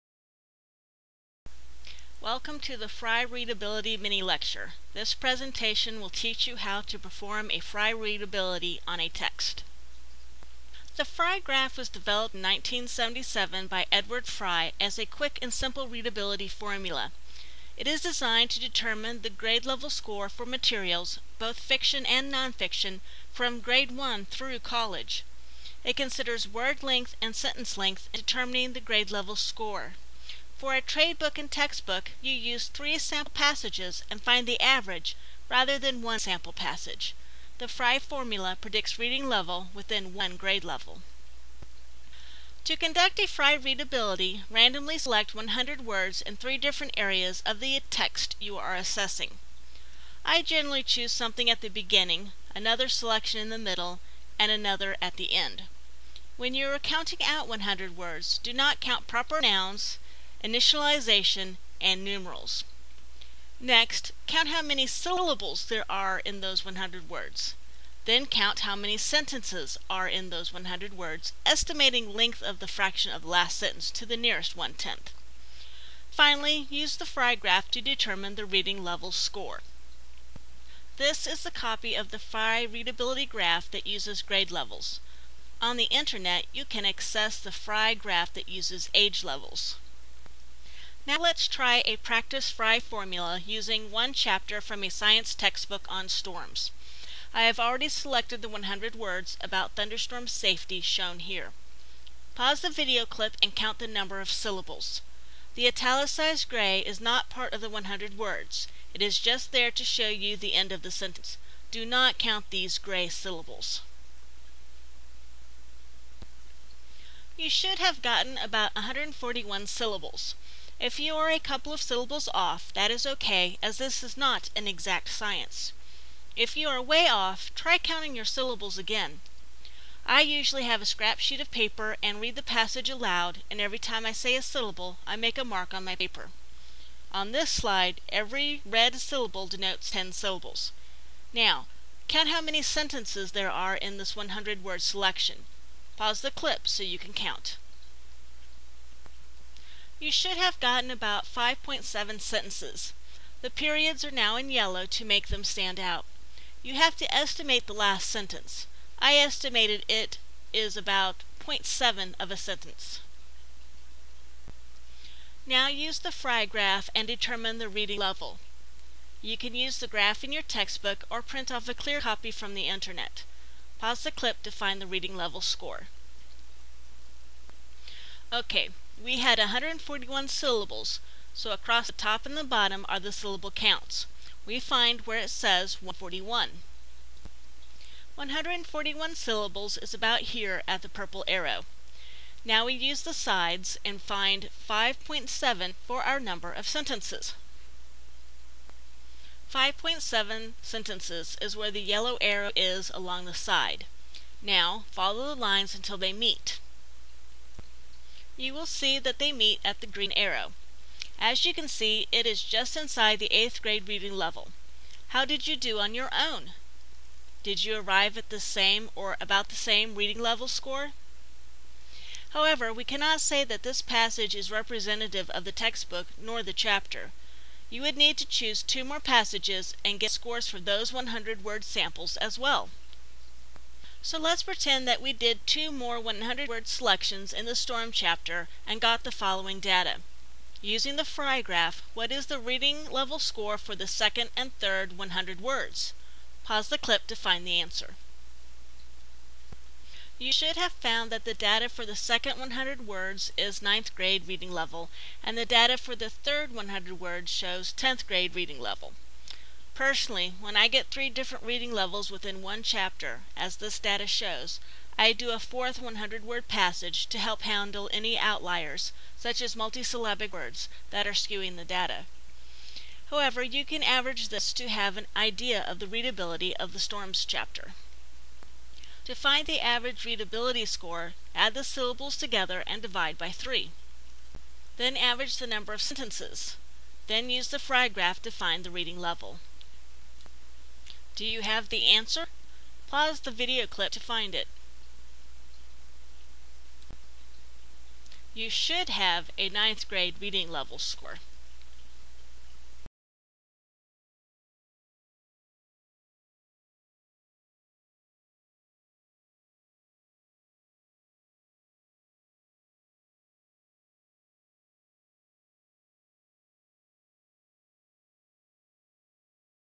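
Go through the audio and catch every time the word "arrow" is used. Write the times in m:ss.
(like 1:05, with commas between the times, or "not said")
3:11, 3:22, 3:30.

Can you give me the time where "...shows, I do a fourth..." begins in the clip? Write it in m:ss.
4:24.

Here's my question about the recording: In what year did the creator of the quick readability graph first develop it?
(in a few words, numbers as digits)
1977.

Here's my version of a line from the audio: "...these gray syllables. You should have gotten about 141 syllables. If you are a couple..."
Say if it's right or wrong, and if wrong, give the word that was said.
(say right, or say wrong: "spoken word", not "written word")
right.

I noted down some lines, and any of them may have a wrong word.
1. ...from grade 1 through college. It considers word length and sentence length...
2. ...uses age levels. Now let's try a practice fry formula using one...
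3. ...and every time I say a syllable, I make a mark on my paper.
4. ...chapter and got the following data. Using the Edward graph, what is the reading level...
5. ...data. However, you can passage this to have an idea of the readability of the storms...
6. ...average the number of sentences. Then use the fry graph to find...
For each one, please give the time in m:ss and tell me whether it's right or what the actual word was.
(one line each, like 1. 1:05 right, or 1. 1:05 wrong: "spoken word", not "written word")
1. 0:23 right
2. 1:28 right
3. 2:13 right
4. 3:57 wrong: "Fry", not "Edward"
5. 4:31 wrong: "average", not "passage"
6. 4:44 right.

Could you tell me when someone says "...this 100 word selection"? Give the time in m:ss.
2:23.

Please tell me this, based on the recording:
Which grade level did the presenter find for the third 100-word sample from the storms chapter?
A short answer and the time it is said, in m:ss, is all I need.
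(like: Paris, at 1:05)
10th grade, at 4:17.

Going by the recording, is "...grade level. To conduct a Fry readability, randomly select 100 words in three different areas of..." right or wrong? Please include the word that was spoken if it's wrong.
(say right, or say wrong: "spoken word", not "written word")
right.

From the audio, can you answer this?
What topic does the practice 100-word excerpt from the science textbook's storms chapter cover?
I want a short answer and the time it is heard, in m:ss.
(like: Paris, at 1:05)
thunderstorm safety, at 1:39.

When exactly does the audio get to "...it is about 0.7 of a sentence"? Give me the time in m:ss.
2:39.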